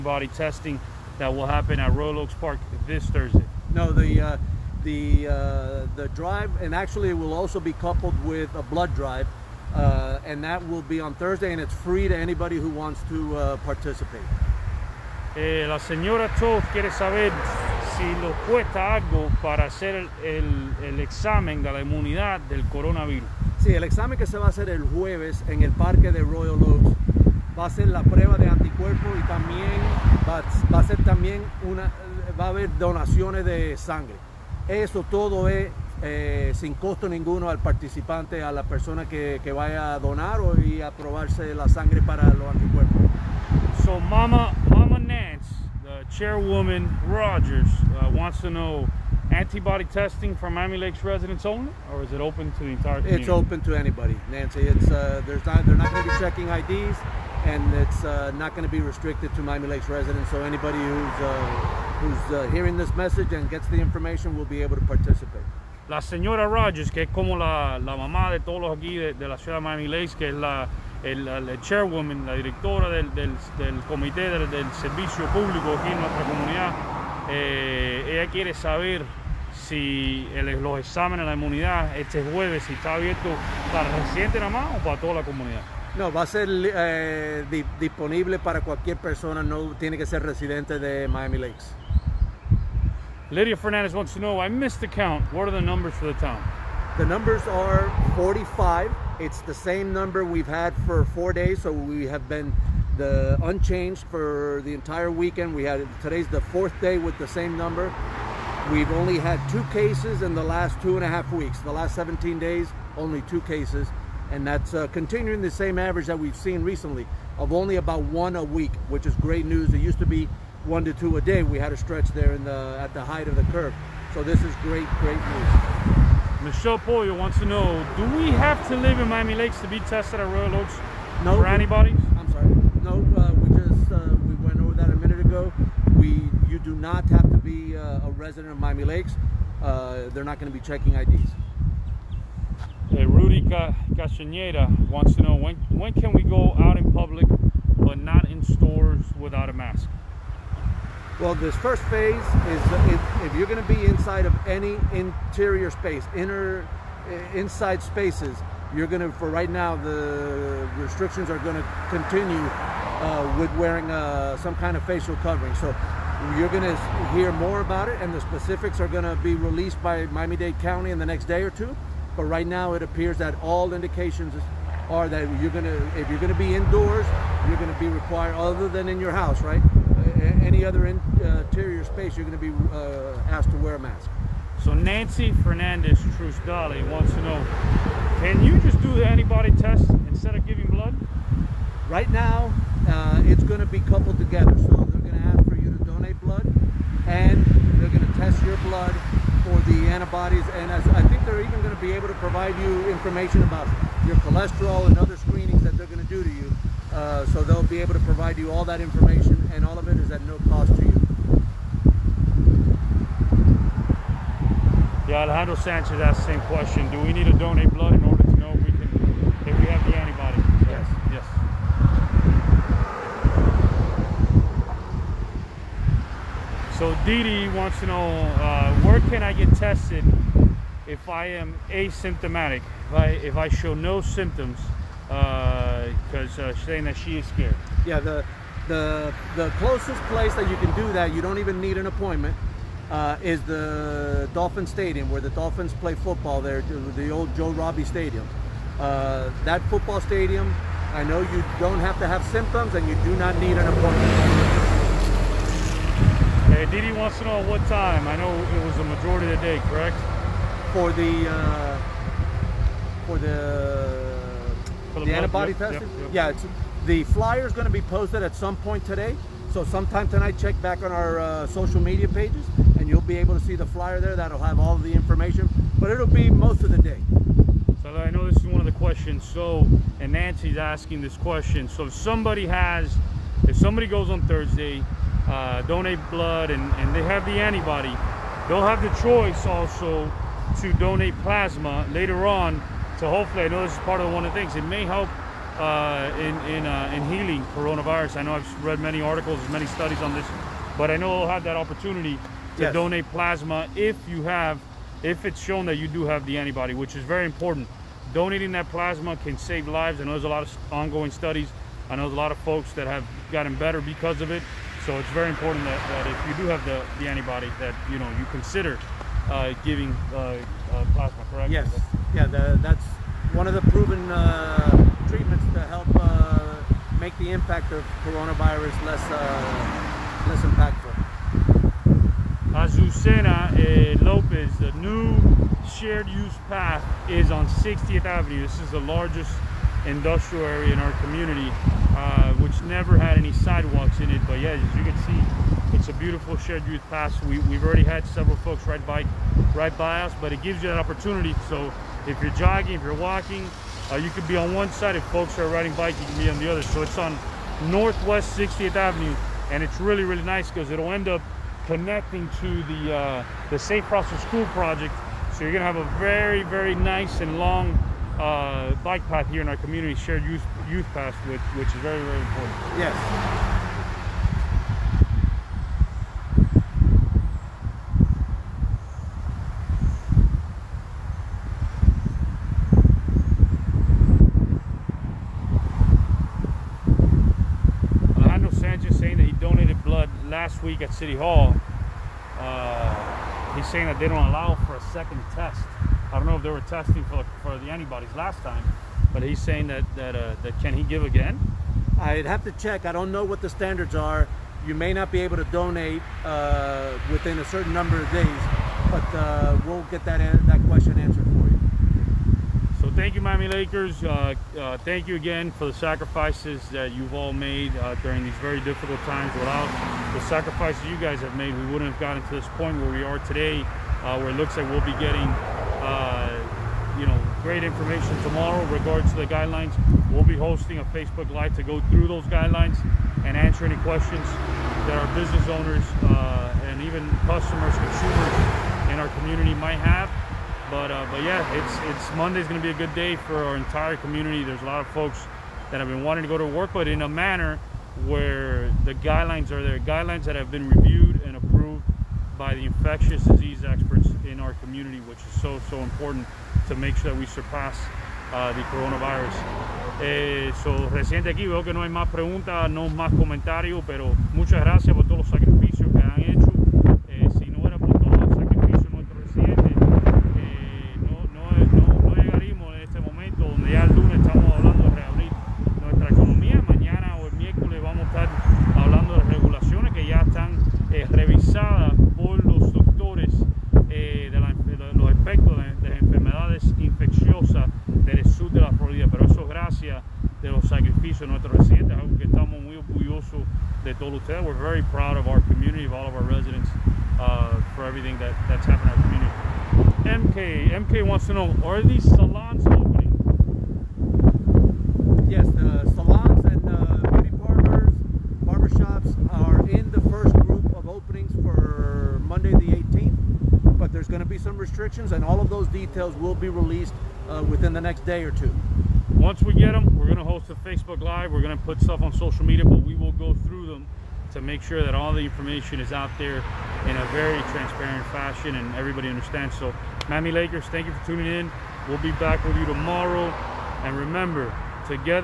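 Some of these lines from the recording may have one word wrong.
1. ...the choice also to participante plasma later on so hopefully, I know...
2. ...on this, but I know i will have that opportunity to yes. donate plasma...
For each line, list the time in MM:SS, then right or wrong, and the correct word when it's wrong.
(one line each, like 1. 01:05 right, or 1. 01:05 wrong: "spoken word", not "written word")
1. 04:48 wrong: "donate", not "participante"
2. 05:00 right.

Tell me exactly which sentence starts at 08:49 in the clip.
So Miami Lakers, thank you for tuning in.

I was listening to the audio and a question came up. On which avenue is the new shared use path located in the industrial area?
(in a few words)
Northwest 60th Avenue.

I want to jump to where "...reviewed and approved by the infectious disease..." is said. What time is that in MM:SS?
07:30.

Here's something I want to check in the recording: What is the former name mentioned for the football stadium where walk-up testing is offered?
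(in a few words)
Joe Robbie Stadium.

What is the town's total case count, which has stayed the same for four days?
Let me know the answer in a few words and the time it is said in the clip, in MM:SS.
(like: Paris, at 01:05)
45, at 01:38.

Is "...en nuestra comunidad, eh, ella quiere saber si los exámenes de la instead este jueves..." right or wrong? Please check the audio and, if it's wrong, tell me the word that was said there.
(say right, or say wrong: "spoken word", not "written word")
wrong: "inmunidad", not "instead".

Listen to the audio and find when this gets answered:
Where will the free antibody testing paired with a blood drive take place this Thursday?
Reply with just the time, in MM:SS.
00:01.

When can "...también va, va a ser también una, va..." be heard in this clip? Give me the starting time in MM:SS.
00:29.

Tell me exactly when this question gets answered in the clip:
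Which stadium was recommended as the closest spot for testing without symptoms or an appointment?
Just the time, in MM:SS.
04:04.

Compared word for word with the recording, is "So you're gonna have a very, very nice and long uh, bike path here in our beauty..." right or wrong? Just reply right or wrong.
wrong.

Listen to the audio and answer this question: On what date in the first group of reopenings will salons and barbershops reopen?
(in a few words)
Monday the 18th.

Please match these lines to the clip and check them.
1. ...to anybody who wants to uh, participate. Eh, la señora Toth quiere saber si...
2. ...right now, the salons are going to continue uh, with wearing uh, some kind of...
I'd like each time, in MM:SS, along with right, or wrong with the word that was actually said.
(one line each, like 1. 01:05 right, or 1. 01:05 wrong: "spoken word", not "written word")
1. 00:12 right
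2. 02:39 wrong: "restrictions", not "salons".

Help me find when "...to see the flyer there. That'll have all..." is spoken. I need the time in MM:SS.
04:33.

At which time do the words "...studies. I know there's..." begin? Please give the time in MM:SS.
05:11.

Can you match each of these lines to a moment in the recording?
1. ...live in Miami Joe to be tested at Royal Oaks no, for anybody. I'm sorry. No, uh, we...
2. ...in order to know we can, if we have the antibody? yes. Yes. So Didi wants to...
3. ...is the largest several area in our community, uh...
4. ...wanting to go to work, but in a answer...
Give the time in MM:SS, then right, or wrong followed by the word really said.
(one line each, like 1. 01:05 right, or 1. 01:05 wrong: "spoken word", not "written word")
1. 02:08 wrong: "Lakes", not "Joe"
2. 03:37 right
3. 05:38 wrong: "industrial", not "several"
4. 07:26 wrong: "manner", not "answer".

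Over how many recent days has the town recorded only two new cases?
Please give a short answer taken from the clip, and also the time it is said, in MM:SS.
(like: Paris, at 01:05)
17, at 01:51.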